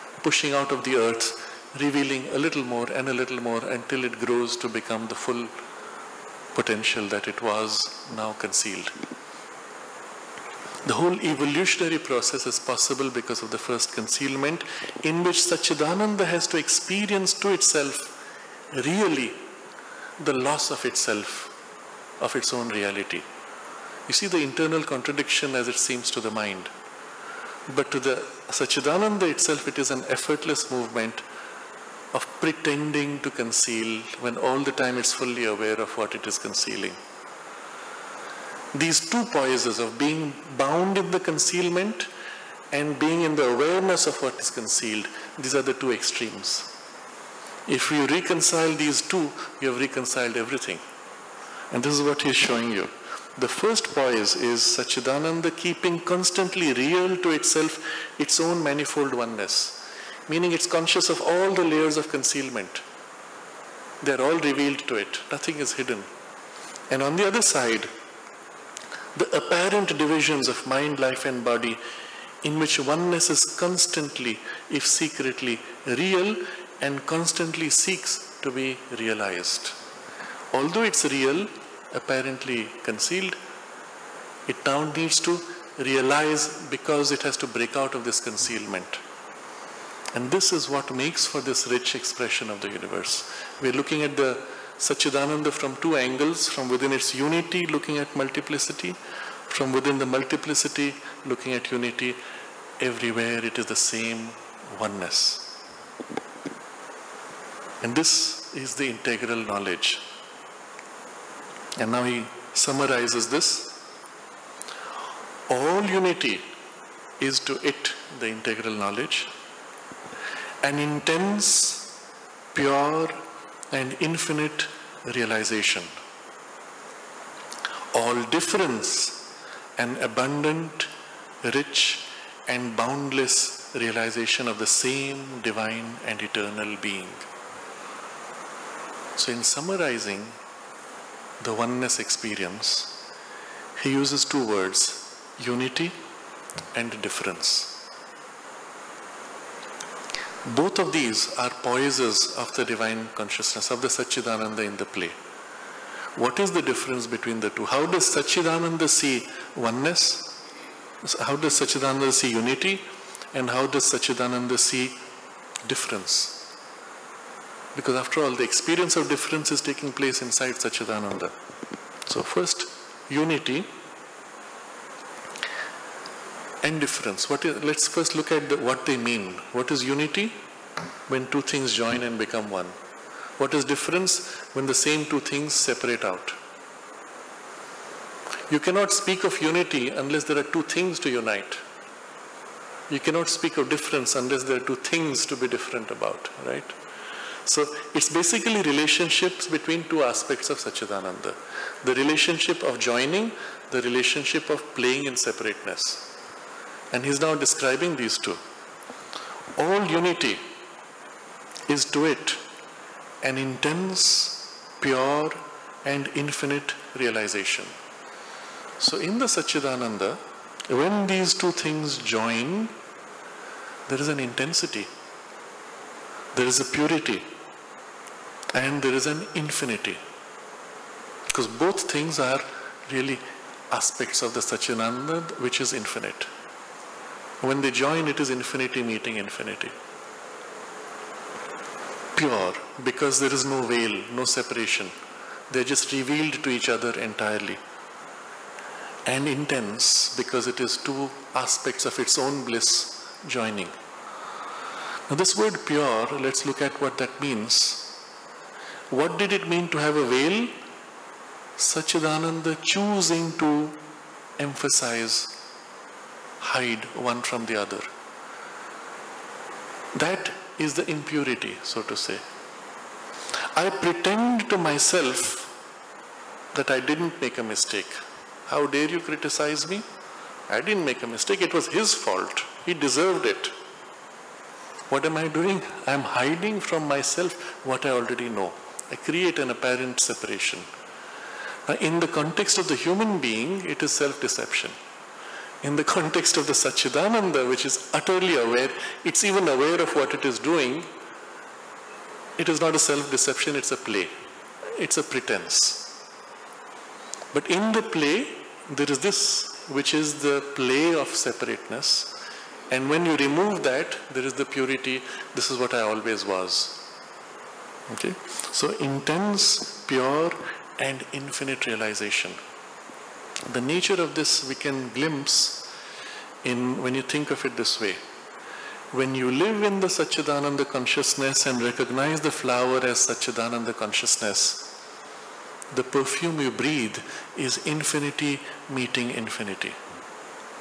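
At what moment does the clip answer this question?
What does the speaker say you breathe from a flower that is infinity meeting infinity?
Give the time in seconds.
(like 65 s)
335 s.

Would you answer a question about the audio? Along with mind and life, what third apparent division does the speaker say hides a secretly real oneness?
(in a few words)
body.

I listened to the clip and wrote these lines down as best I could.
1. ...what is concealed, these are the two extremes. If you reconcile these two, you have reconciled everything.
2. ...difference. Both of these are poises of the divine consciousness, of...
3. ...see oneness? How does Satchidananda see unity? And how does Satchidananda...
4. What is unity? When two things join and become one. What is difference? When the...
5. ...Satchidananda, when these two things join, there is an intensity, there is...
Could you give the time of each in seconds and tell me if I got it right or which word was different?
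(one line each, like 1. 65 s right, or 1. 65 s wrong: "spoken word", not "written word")
1. 44 s right
2. 147 s right
3. 158 s right
4. 179 s right
5. 219 s right.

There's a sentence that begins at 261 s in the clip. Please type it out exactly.
Satchidananda choosing to emphasize hide one from the other.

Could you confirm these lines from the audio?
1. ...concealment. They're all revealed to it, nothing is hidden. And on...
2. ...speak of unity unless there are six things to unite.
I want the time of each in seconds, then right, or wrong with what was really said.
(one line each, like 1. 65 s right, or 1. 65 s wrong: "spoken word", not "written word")
1. 62 s right
2. 188 s wrong: "two", not "six".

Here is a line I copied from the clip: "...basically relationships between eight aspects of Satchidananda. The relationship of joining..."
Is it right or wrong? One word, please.
wrong.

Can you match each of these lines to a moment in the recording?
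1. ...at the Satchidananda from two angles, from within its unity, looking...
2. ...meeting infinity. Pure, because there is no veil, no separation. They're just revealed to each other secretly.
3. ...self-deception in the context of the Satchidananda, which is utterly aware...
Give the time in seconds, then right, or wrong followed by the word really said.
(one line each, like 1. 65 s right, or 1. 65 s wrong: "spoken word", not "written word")
1. 94 s right
2. 238 s wrong: "entirely", not "secretly"
3. 293 s right.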